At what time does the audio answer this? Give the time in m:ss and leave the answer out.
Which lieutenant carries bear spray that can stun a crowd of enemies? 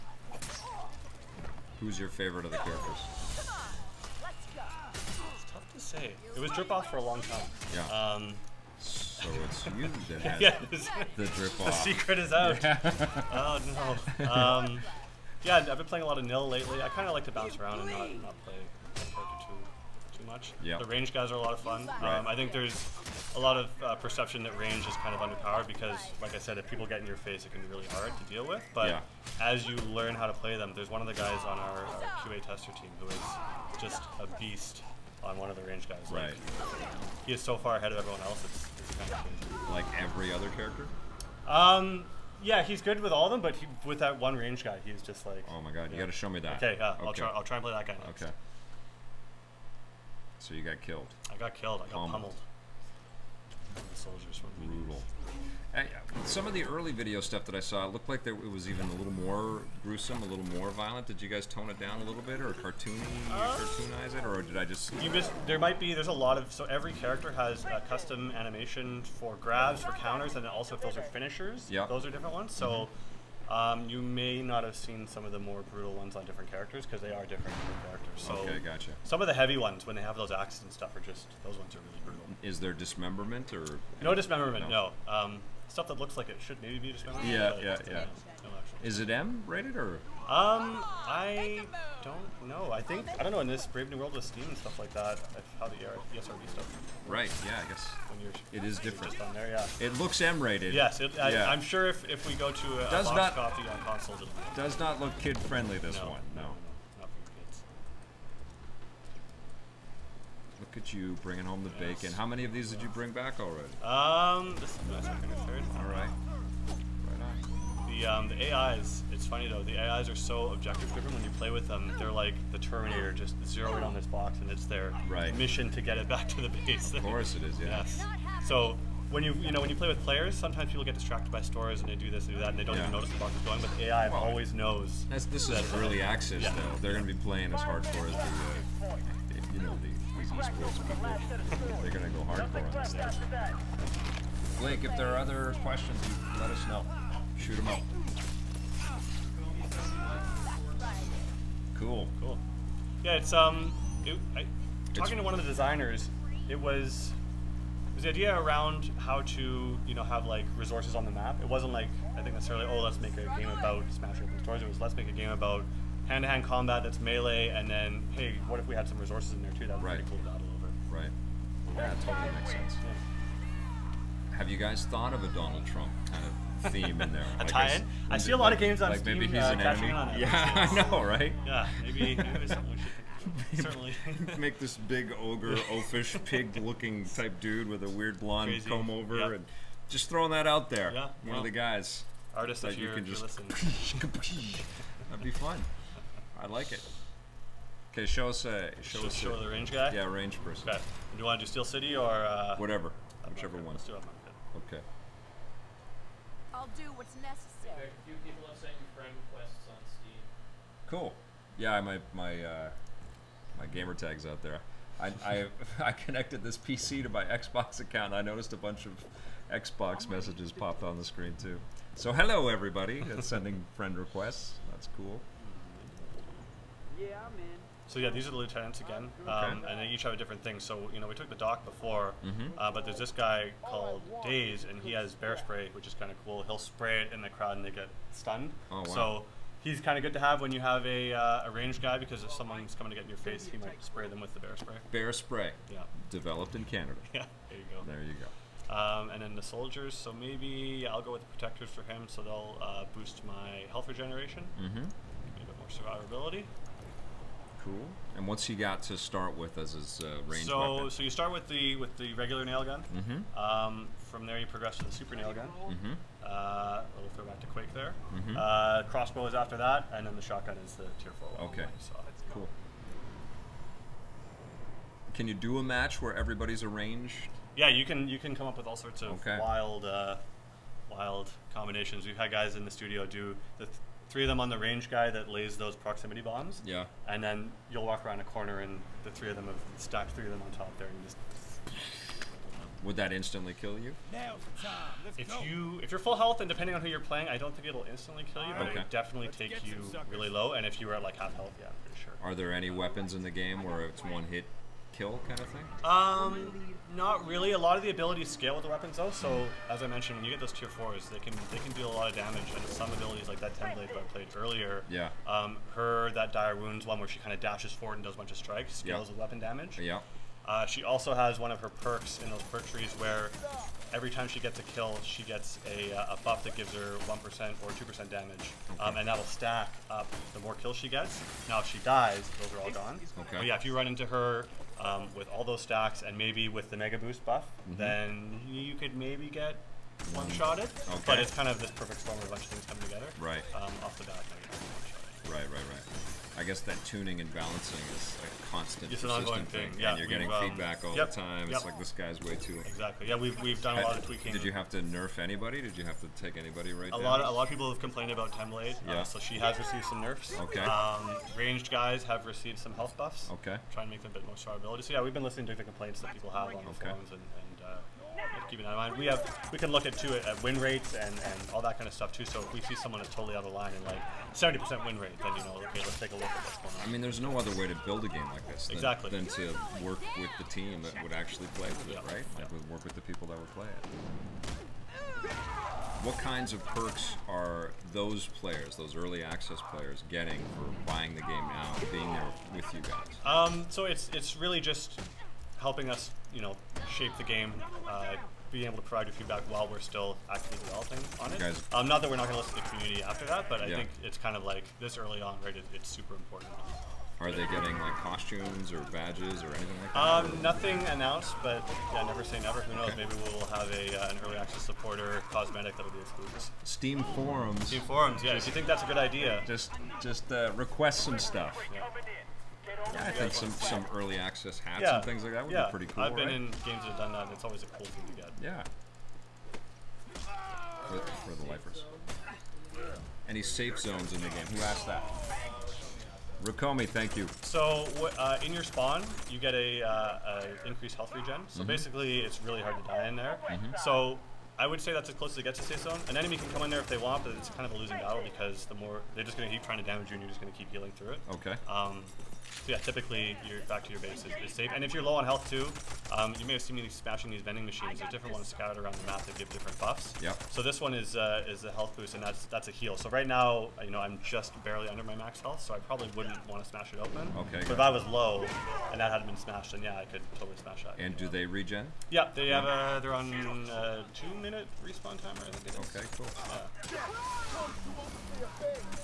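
3:54.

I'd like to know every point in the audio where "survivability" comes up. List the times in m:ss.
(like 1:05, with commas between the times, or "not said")
4:15, 6:04.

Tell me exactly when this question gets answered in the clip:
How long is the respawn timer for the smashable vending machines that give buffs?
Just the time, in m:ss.
7:54.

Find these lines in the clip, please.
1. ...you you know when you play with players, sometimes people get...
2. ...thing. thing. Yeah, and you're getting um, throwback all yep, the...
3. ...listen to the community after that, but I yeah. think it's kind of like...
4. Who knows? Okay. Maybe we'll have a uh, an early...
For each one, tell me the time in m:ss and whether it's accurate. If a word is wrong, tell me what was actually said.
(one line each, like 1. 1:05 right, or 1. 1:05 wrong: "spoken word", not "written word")
1. 2:09 right
2. 5:49 wrong: "feedback", not "throwback"
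3. 6:42 right
4. 6:52 right.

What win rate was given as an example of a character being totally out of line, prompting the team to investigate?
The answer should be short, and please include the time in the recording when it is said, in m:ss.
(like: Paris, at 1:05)
70%, at 6:14.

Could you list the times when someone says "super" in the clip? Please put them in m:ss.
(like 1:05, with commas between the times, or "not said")
4:24, 6:45.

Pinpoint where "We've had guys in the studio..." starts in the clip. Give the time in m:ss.
4:42.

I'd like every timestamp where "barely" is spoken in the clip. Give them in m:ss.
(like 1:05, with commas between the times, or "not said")
7:44.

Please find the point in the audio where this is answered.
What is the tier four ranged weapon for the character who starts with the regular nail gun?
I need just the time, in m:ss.
4:30.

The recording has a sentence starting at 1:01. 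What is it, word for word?
Did you guys tone it down a little bit, or cartoony, uh, cartoonize it, or did I just?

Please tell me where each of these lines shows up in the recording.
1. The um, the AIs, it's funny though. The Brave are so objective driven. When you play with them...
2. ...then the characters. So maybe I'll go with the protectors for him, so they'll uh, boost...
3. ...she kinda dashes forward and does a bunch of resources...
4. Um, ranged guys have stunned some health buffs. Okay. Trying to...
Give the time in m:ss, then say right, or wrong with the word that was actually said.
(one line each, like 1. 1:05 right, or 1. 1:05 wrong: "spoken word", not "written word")
1. 1:57 wrong: "AIs", not "Brave"
2. 4:09 wrong: "soldiers", not "characters"
3. 5:17 wrong: "strikes", not "resources"
4. 6:00 wrong: "received", not "stunned".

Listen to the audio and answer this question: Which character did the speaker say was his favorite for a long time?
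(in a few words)
Dripov.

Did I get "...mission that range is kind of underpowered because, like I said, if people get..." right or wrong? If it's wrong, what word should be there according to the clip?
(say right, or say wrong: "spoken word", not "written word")
wrong: "perception", not "mission".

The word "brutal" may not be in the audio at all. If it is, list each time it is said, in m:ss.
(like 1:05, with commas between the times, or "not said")
0:54, 1:15, 1:22.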